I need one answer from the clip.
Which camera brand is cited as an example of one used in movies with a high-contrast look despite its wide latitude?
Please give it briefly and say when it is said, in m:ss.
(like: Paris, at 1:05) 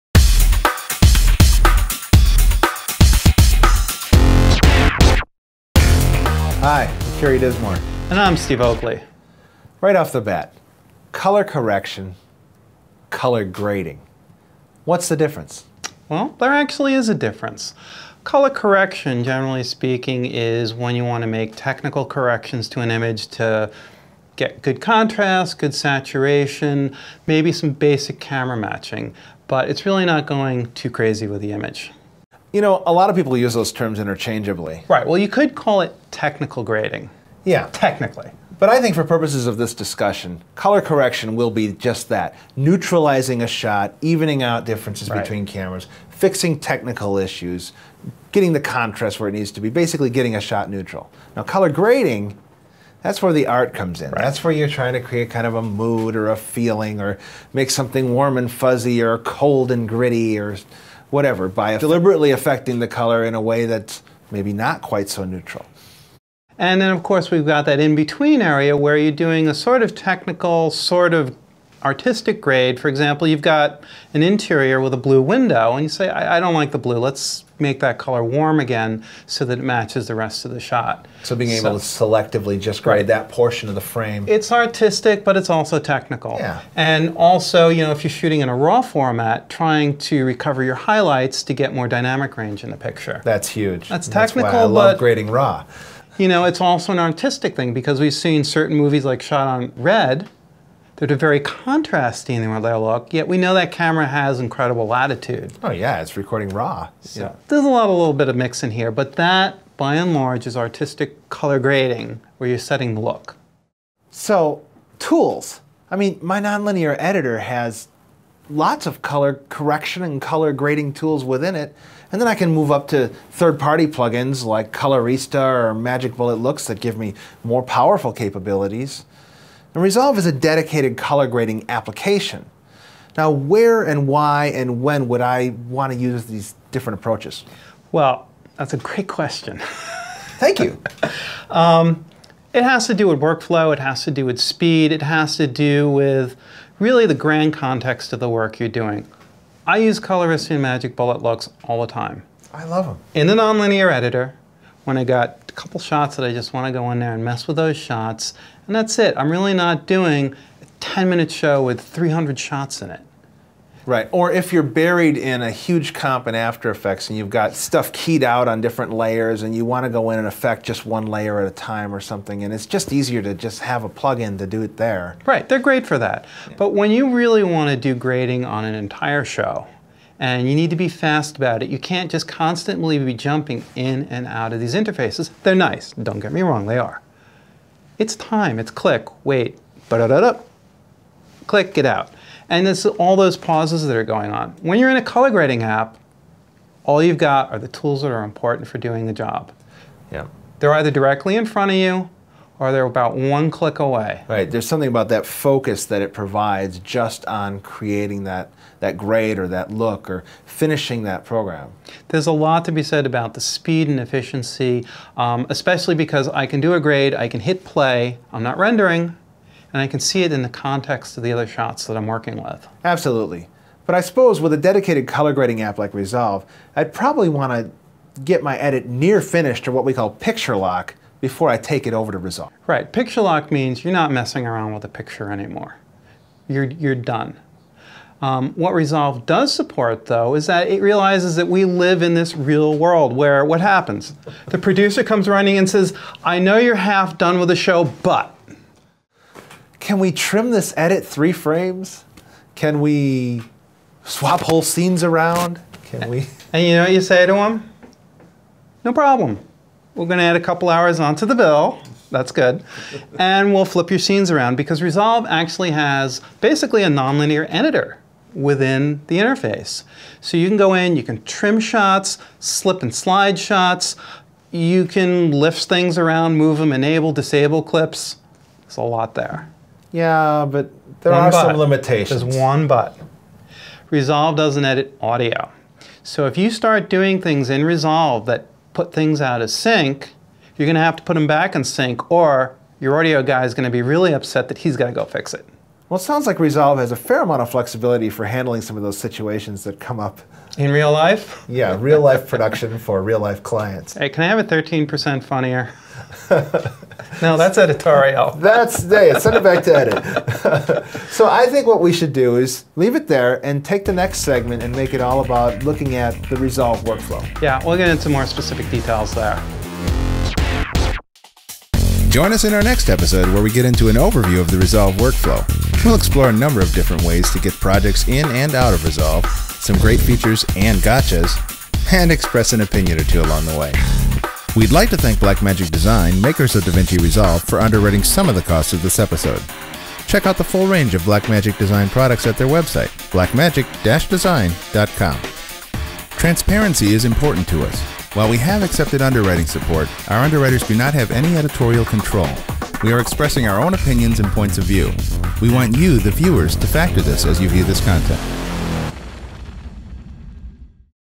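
Red, at 1:39.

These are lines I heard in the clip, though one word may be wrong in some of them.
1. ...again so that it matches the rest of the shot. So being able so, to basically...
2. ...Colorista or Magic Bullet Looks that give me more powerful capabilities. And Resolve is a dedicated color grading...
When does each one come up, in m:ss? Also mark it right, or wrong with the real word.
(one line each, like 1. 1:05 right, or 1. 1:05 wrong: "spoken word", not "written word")
1. 1:18 wrong: "selectively", not "basically"
2. 2:04 right.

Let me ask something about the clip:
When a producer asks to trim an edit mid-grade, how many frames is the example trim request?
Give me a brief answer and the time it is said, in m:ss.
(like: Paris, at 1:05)
3, at 4:11.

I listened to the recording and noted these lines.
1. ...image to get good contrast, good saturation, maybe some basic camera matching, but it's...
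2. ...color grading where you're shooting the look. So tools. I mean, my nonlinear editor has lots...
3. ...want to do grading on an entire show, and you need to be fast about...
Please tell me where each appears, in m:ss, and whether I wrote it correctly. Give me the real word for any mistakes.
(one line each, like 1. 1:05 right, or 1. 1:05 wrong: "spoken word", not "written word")
1. 0:22 right
2. 1:51 wrong: "setting", not "shooting"
3. 2:57 right.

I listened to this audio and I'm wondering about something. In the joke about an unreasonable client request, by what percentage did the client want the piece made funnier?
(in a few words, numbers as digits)
13%.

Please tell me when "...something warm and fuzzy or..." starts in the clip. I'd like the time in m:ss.
0:57.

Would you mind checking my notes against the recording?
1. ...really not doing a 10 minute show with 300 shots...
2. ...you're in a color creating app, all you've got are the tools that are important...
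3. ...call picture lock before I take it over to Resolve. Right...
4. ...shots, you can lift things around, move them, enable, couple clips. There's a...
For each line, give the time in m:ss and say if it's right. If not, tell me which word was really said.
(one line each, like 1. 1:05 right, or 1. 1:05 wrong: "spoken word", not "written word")
1. 2:39 right
2. 3:14 wrong: "grading", not "creating"
3. 3:49 right
4. 4:33 wrong: "disable", not "couple".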